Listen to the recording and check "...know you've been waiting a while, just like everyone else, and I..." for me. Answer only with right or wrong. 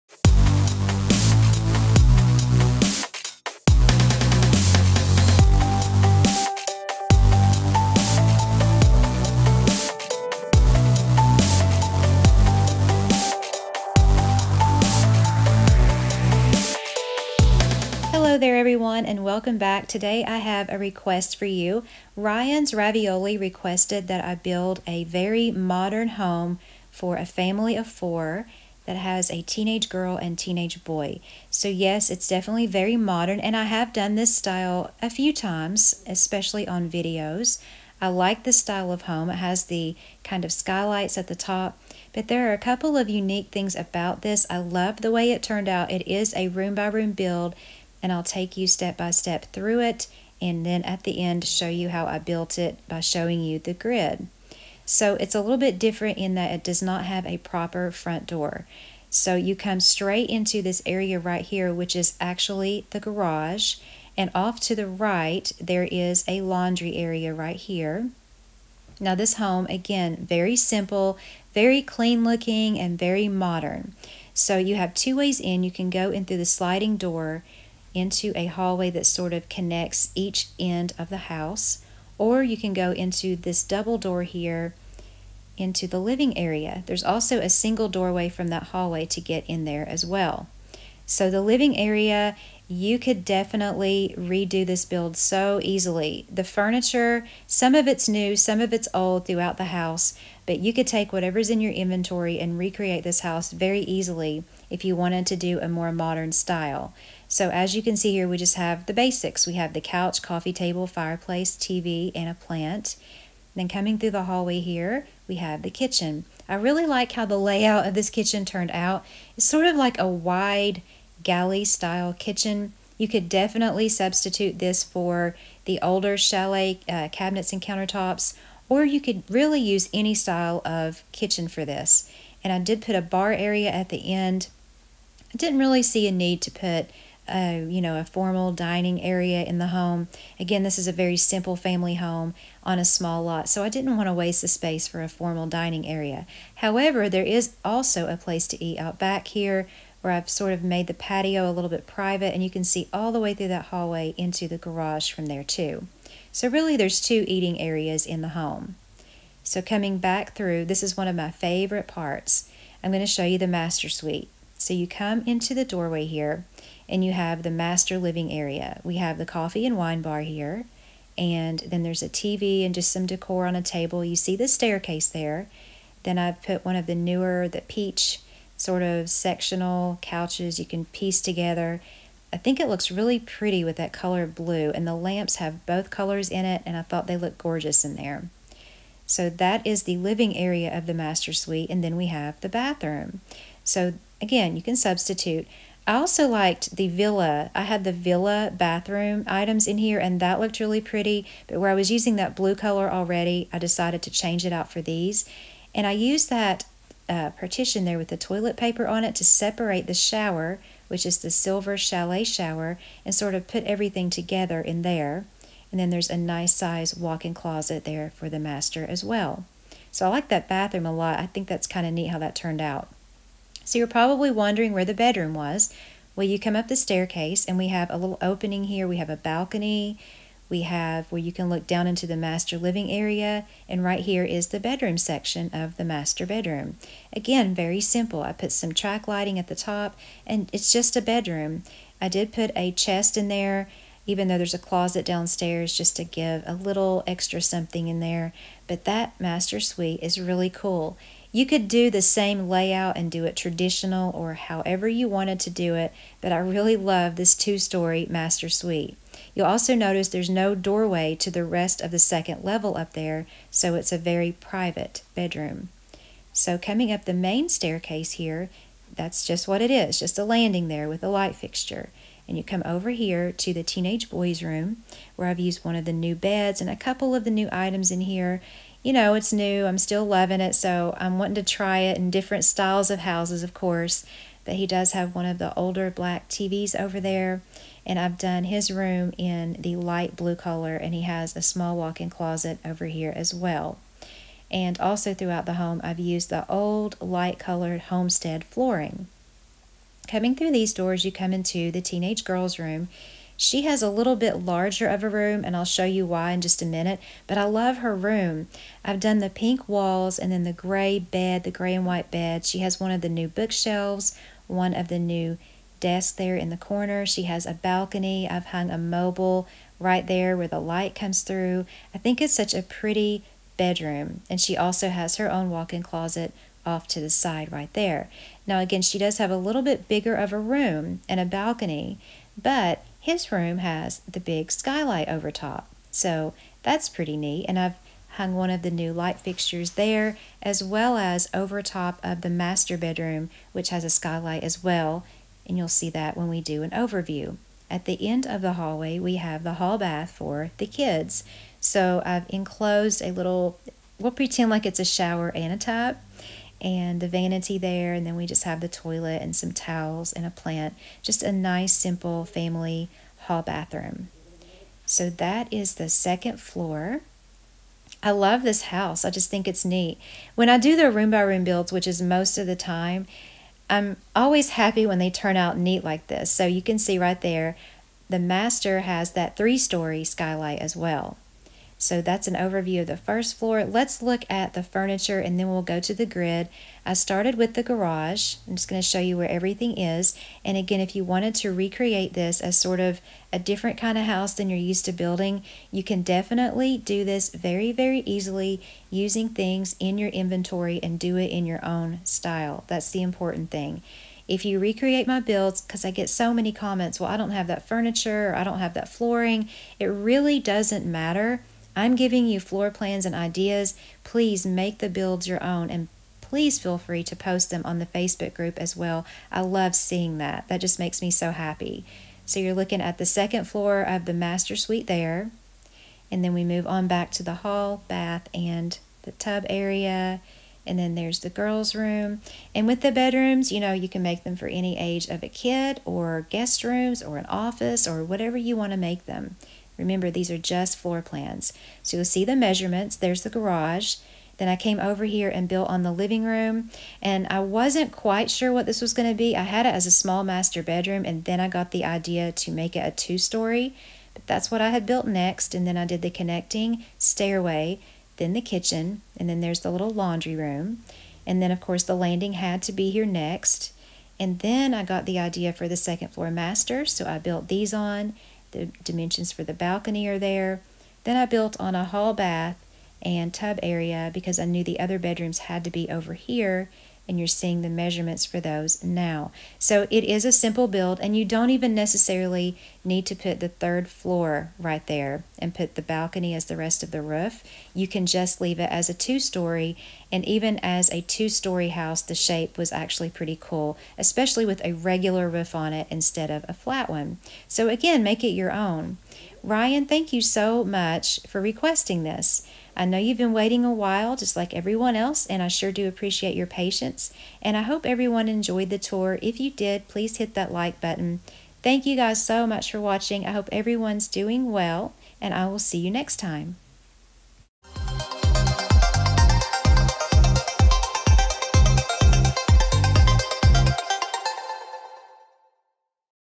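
right.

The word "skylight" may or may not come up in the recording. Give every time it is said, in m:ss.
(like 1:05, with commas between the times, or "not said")
0:40, 5:34, 5:43, 6:20.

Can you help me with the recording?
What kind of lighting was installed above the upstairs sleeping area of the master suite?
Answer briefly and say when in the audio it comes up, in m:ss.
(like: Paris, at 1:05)
Track lighting, at 3:58.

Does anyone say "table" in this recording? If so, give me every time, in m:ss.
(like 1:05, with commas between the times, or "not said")
1:50, 2:53.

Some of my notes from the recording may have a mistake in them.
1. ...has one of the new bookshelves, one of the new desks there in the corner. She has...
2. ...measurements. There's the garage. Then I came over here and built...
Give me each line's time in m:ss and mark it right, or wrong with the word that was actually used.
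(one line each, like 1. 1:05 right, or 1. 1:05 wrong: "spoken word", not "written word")
1. 5:12 right
2. 7:22 right.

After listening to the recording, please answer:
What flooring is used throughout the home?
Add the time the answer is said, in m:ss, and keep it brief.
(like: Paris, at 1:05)
Light colored homestead flooring, at 4:56.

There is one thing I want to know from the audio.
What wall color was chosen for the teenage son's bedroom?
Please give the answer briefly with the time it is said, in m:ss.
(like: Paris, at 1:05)
Light blue, at 4:49.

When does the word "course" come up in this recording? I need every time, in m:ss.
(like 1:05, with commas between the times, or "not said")
4:43, 7:41.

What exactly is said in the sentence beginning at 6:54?
Please make the builds your own and please feel free to post them on the Facebook group as well.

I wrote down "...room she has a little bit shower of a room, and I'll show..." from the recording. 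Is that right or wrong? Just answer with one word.
wrong.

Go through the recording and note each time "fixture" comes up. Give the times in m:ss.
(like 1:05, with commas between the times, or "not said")
4:31, 5:39.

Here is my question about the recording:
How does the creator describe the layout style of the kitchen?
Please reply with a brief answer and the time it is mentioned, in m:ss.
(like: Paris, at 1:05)
Wide galley style, at 2:00.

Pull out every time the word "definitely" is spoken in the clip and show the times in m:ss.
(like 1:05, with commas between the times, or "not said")
0:32, 1:33, 2:03, 6:36.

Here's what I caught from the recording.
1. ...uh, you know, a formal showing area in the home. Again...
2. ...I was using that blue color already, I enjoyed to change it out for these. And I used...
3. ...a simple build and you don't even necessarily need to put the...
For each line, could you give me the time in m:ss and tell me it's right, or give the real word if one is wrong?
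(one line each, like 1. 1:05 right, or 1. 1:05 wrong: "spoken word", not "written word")
1. 2:17 wrong: "dining", not "showing"
2. 3:21 wrong: "decided", not "enjoyed"
3. 8:00 right.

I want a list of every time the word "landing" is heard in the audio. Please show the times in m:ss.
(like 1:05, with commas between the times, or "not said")
4:30, 7:41.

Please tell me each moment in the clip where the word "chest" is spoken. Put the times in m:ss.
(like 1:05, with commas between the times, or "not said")
4:02.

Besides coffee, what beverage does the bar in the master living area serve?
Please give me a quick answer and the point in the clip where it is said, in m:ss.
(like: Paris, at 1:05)
Wine, at 2:49.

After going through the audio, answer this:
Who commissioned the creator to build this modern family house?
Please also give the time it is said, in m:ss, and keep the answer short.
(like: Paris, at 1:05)
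Ryan's Ravioli, at 0:22.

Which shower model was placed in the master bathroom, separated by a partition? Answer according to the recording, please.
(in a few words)
Silver chalet shower.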